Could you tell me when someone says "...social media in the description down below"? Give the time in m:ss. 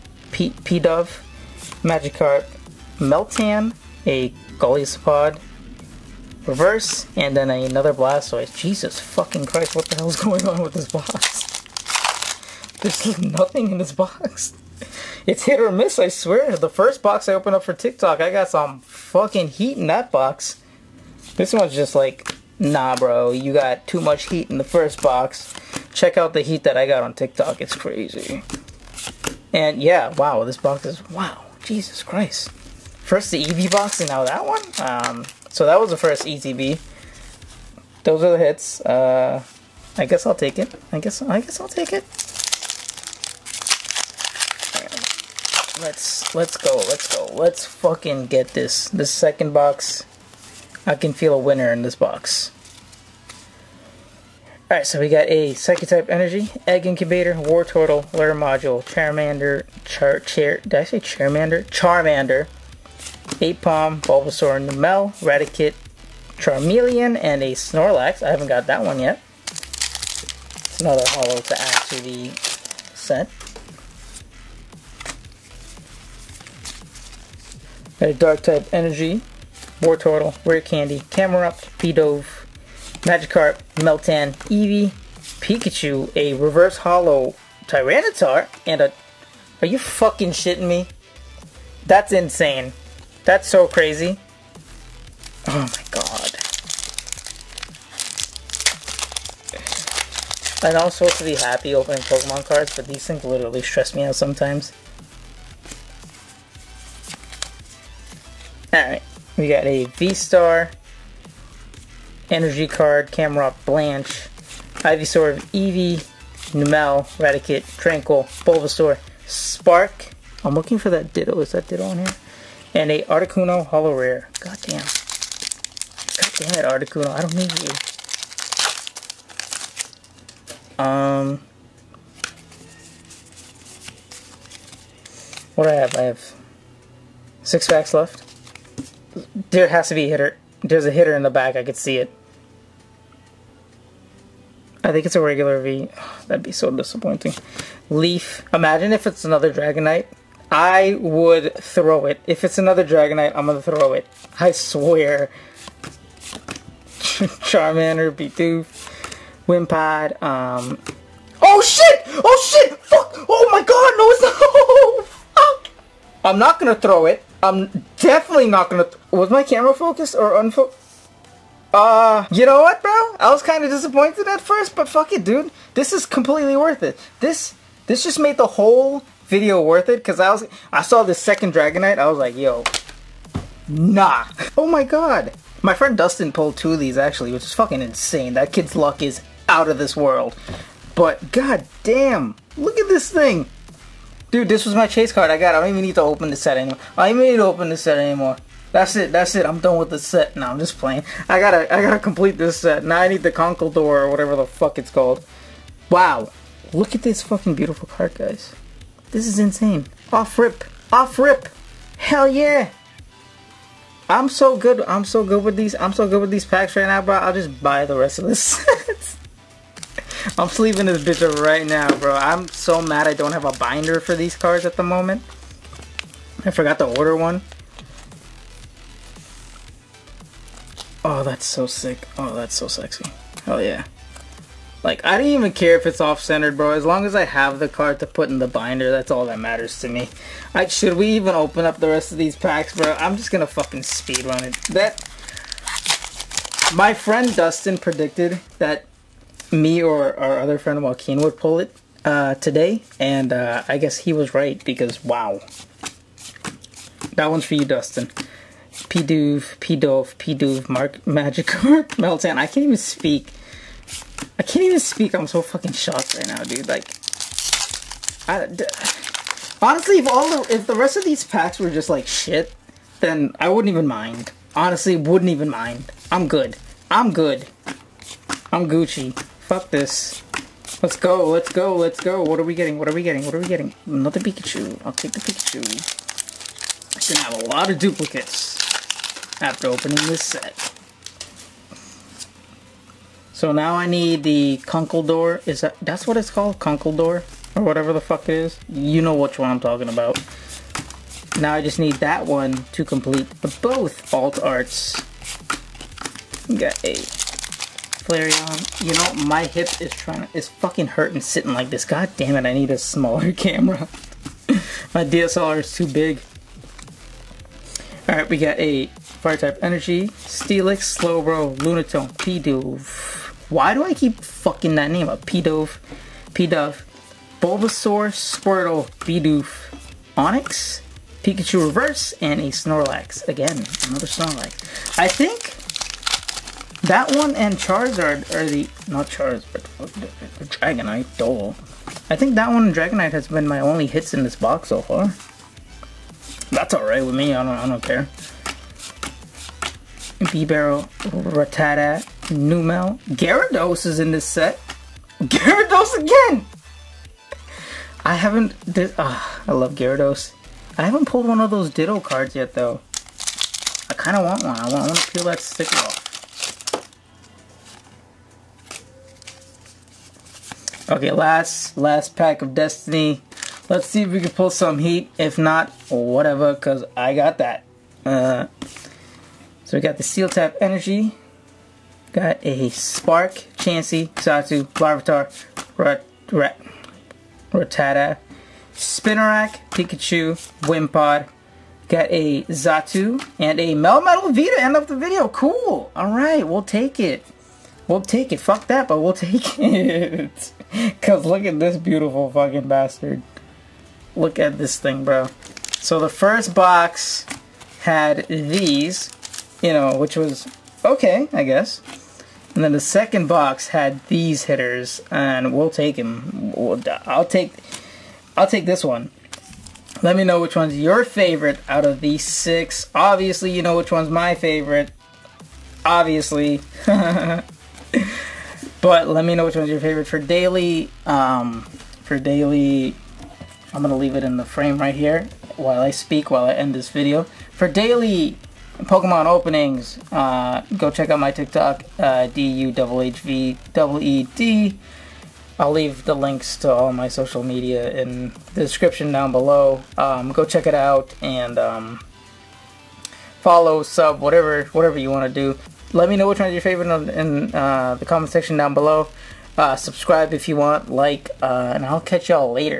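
7:27.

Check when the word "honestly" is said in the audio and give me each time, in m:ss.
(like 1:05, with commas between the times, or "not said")
4:29, 4:34.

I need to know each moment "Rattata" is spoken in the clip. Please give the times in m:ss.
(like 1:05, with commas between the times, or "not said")
5:51, 6:27.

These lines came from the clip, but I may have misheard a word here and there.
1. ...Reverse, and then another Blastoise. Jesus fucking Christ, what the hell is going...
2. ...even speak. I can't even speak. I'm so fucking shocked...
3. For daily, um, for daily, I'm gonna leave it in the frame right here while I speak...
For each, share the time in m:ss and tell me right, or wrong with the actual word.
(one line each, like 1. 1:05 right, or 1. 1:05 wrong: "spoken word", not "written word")
1. 0:06 right
2. 4:22 right
3. 7:10 right.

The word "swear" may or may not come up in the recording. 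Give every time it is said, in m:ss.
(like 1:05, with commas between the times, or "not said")
0:16, 2:34.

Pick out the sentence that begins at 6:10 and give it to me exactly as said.
Okay, last last pack of Destiny.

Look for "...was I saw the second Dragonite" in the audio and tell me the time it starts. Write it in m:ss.
3:00.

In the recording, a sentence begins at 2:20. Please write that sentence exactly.
There's a hitter in the back.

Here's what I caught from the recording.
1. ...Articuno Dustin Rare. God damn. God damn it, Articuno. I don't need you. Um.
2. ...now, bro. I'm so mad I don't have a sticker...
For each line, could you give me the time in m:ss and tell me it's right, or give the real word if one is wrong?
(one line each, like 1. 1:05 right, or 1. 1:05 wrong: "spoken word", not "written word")
1. 2:03 wrong: "Holo", not "Dustin"
2. 3:41 wrong: "binder", not "sticker".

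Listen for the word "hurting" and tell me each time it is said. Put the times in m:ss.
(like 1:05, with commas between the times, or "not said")
5:10.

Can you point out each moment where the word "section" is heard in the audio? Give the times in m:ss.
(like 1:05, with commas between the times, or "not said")
7:38.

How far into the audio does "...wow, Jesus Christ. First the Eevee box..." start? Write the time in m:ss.
0:31.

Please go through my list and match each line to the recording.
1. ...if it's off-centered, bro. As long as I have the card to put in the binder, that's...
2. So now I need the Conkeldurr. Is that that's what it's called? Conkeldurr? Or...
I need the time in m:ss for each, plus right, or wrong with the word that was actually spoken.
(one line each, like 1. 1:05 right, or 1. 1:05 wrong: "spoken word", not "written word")
1. 3:55 right
2. 4:53 right.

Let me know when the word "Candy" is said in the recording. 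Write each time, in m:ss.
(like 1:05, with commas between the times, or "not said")
1:20.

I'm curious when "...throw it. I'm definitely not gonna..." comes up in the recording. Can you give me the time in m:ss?
2:46.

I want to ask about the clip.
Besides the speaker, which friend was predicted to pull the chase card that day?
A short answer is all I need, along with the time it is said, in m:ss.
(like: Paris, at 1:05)
Joaquin, at 4:10.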